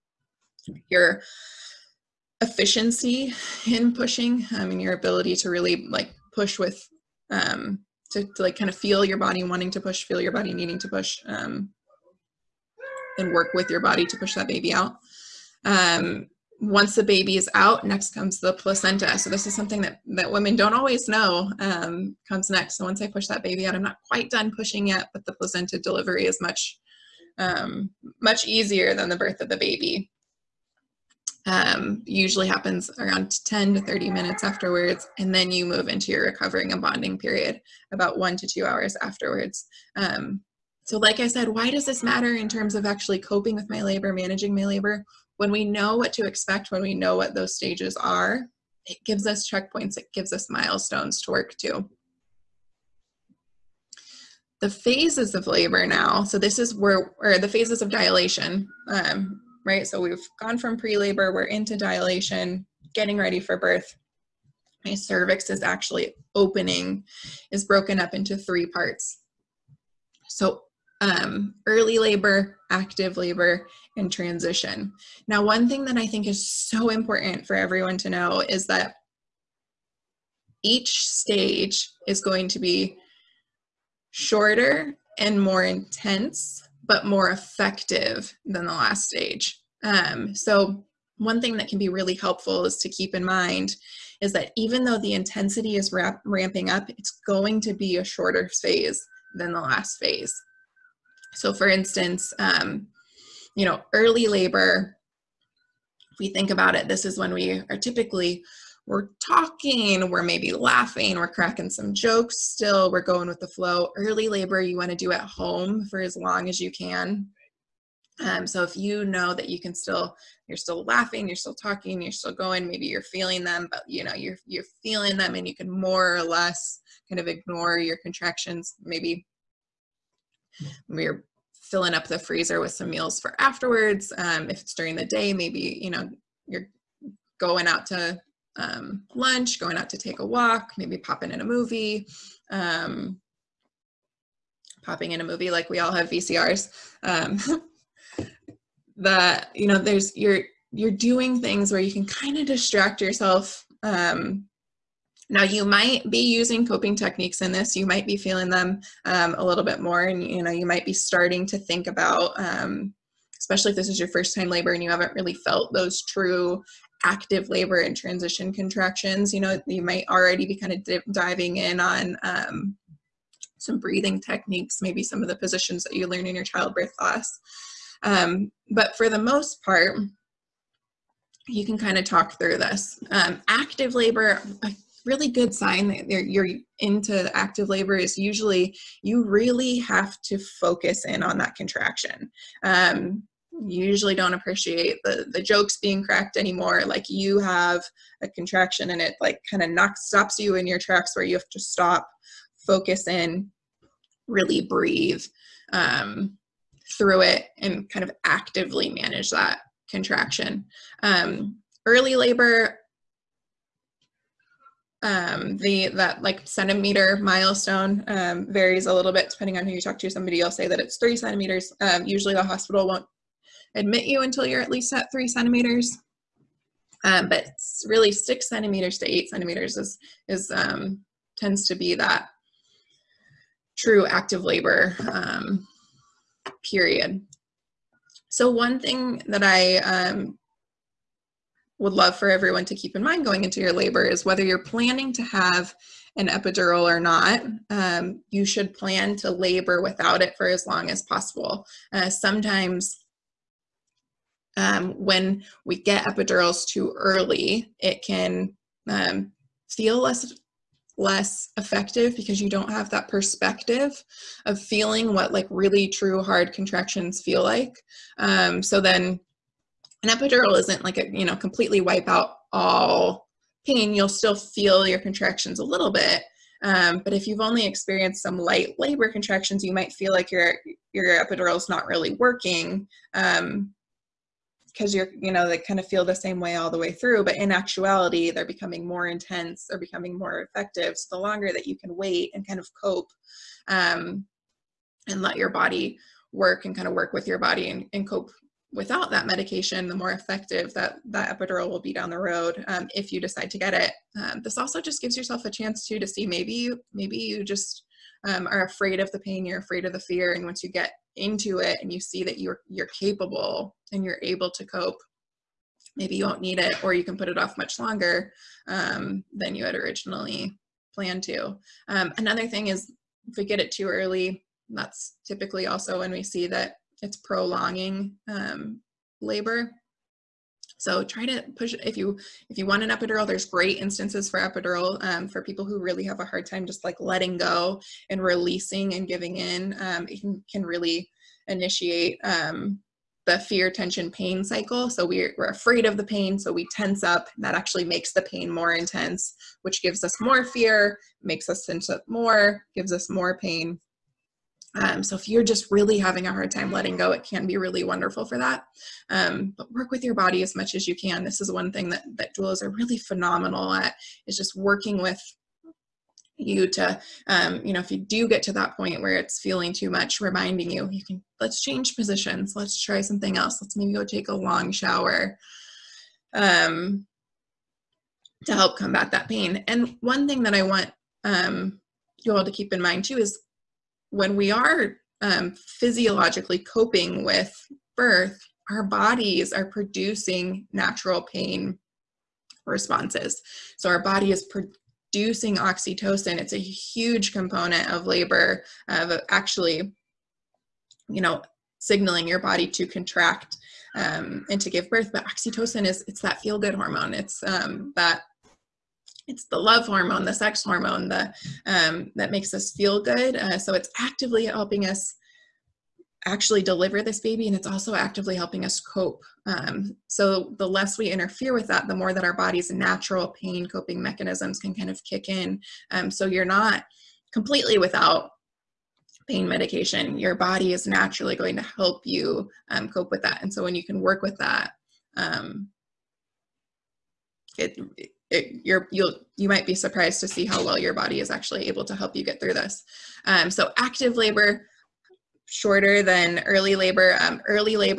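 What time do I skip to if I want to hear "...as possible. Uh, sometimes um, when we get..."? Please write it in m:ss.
4:10.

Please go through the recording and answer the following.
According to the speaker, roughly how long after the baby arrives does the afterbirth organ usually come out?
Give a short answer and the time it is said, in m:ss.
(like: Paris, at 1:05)
10 to 30 minutes, at 0:33.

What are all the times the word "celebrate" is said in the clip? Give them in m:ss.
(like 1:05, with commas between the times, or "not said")
not said.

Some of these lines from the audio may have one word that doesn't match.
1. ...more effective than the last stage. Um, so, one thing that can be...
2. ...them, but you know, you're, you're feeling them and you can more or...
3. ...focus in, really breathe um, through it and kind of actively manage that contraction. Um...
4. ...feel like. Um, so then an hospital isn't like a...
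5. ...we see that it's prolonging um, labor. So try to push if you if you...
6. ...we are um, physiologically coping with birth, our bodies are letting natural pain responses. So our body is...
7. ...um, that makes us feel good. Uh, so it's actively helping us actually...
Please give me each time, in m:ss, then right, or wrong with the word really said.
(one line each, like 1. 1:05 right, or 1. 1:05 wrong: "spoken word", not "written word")
1. 1:27 right
2. 2:03 right
3. 3:22 right
4. 4:27 wrong: "epidural", not "hospital"
5. 5:26 right
6. 6:24 wrong: "producing", not "letting"
7. 6:51 right.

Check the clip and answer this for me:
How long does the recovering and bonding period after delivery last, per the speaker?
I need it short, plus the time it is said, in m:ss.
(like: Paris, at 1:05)
1 to 2 hours, at 0:38.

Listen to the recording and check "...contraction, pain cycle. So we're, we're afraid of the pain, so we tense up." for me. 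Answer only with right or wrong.
wrong.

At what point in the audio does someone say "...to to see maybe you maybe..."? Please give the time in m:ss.
5:05.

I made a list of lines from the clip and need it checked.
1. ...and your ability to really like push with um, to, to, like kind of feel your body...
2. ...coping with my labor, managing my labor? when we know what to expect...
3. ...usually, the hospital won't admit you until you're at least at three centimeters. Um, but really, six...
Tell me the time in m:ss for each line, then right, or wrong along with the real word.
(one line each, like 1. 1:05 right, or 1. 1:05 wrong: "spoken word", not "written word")
1. 0:04 right
2. 0:43 right
3. 3:42 right.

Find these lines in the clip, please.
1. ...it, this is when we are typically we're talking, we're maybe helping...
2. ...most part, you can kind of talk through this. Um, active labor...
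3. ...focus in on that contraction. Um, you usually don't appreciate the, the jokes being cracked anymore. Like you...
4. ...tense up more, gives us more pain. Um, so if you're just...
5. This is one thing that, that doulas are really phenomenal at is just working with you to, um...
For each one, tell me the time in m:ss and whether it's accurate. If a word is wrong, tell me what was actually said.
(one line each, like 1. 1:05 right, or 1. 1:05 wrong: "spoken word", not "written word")
1. 1:46 wrong: "laughing", not "helping"
2. 2:59 right
3. 3:10 right
4. 5:51 right
5. 6:01 right.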